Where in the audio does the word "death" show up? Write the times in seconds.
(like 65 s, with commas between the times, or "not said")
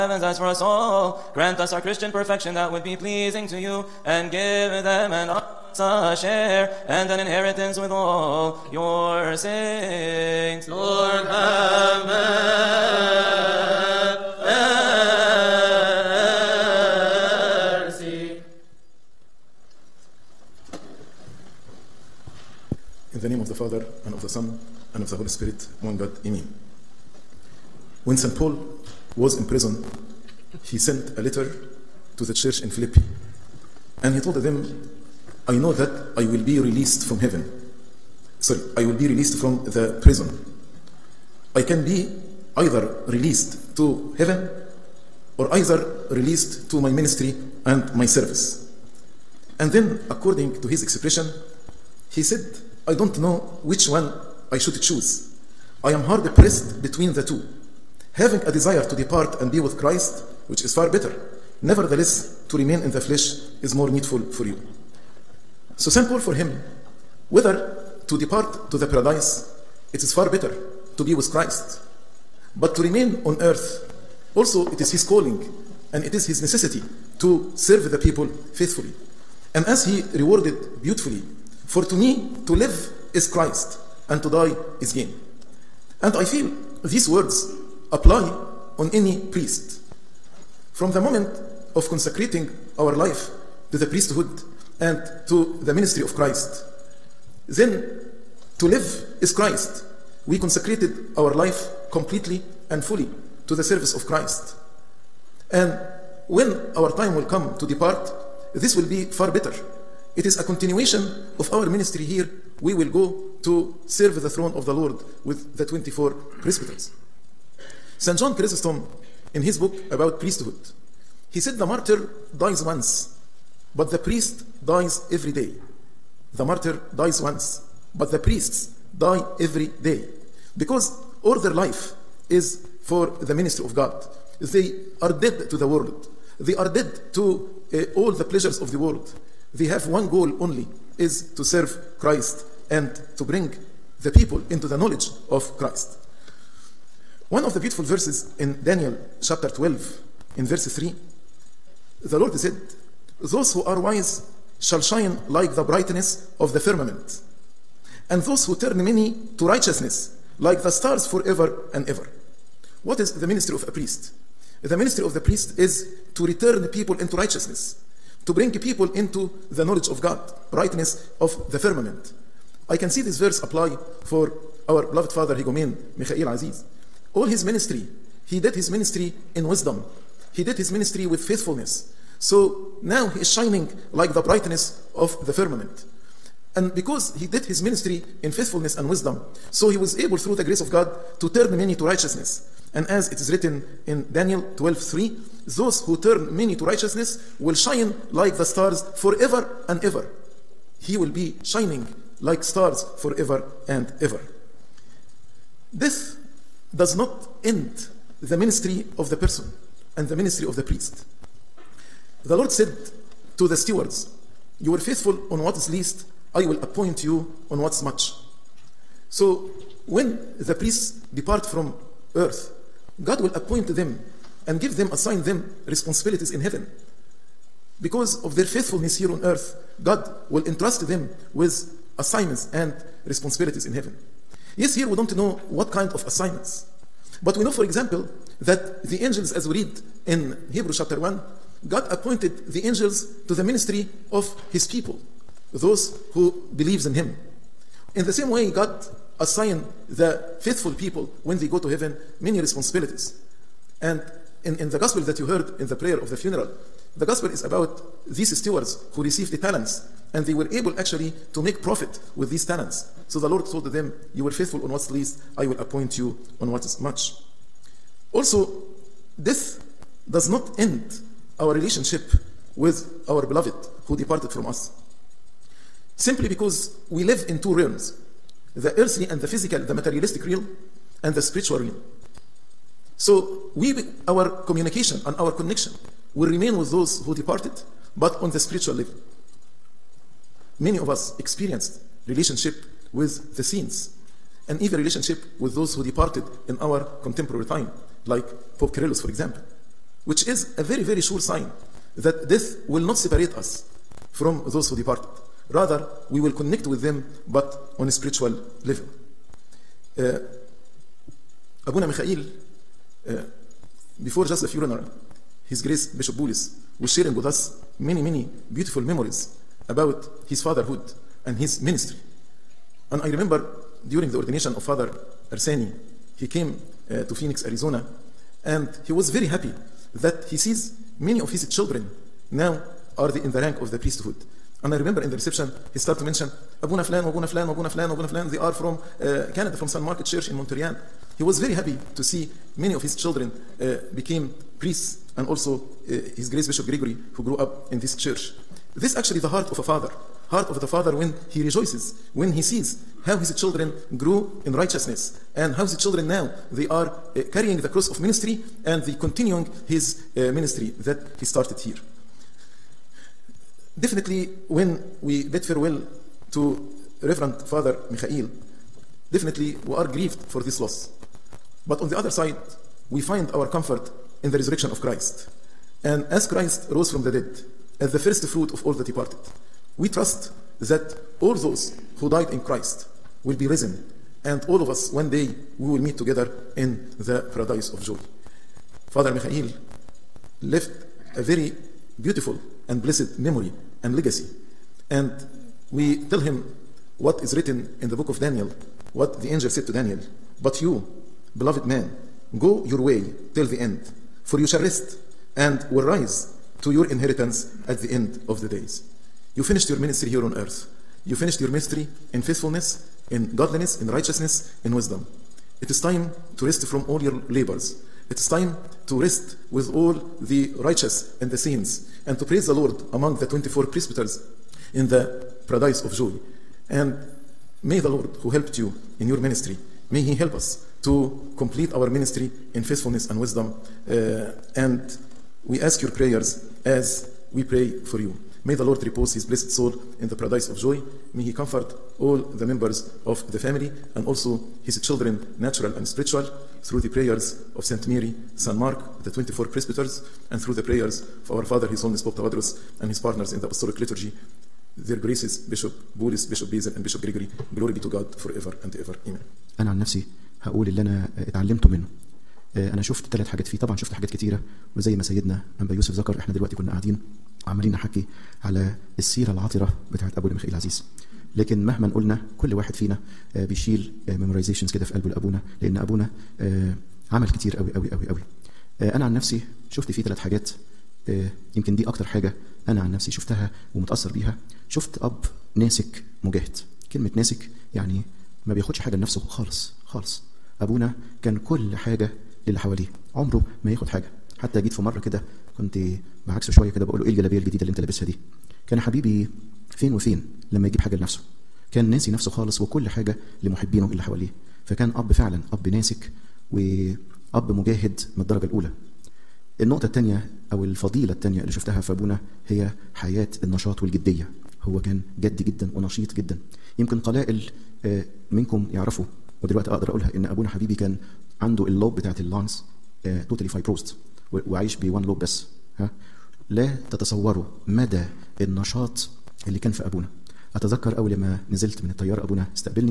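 269 s, 302 s.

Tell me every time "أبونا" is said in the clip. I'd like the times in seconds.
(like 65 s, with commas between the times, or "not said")
470 s, 490 s, 511 s, 520 s.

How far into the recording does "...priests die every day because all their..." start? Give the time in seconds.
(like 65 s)
128 s.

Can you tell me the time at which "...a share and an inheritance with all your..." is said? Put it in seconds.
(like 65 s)
5 s.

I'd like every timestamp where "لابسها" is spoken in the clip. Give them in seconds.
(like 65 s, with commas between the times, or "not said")
497 s.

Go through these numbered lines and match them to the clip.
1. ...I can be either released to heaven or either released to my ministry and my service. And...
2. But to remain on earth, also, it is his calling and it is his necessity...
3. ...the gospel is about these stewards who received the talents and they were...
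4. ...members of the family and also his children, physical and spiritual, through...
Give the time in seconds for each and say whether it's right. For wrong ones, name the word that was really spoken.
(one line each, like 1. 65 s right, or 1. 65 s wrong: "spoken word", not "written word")
1. 41 s right
2. 72 s right
3. 256 s right
4. 442 s wrong: "natural", not "physical".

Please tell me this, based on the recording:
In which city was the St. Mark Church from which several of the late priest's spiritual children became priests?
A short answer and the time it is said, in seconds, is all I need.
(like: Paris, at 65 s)
Montreal, at 340 s.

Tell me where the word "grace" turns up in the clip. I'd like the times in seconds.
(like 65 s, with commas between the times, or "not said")
190 s, 315 s, 346 s, 454 s.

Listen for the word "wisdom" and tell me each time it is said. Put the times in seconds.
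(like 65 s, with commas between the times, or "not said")
179 s, 188 s, 414 s, 433 s.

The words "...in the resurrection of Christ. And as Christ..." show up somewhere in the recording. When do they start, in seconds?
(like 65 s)
374 s.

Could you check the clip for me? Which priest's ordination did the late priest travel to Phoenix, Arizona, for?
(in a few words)
Father Arseni.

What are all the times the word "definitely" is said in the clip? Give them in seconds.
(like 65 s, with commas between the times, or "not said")
363 s, 369 s.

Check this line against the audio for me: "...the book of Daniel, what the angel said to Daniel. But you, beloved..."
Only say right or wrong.
right.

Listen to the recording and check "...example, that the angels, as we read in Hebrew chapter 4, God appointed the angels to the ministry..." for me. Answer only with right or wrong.
wrong.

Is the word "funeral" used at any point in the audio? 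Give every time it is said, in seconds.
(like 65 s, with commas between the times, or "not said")
256 s, 314 s.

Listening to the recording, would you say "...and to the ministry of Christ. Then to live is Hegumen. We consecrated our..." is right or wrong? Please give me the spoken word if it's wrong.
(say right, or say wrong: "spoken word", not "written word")
wrong: "Christ", not "Hegumen".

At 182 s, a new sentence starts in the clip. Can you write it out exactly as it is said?
So now he is shining like the brightness of the firmament.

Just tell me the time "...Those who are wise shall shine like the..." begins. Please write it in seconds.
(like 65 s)
153 s.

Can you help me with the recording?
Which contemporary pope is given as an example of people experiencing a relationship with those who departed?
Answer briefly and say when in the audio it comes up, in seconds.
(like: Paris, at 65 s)
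Pope Kyrillos, at 298 s.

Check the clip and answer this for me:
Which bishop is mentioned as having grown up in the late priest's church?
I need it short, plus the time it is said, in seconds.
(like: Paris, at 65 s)
Bishop Gregory, at 346 s.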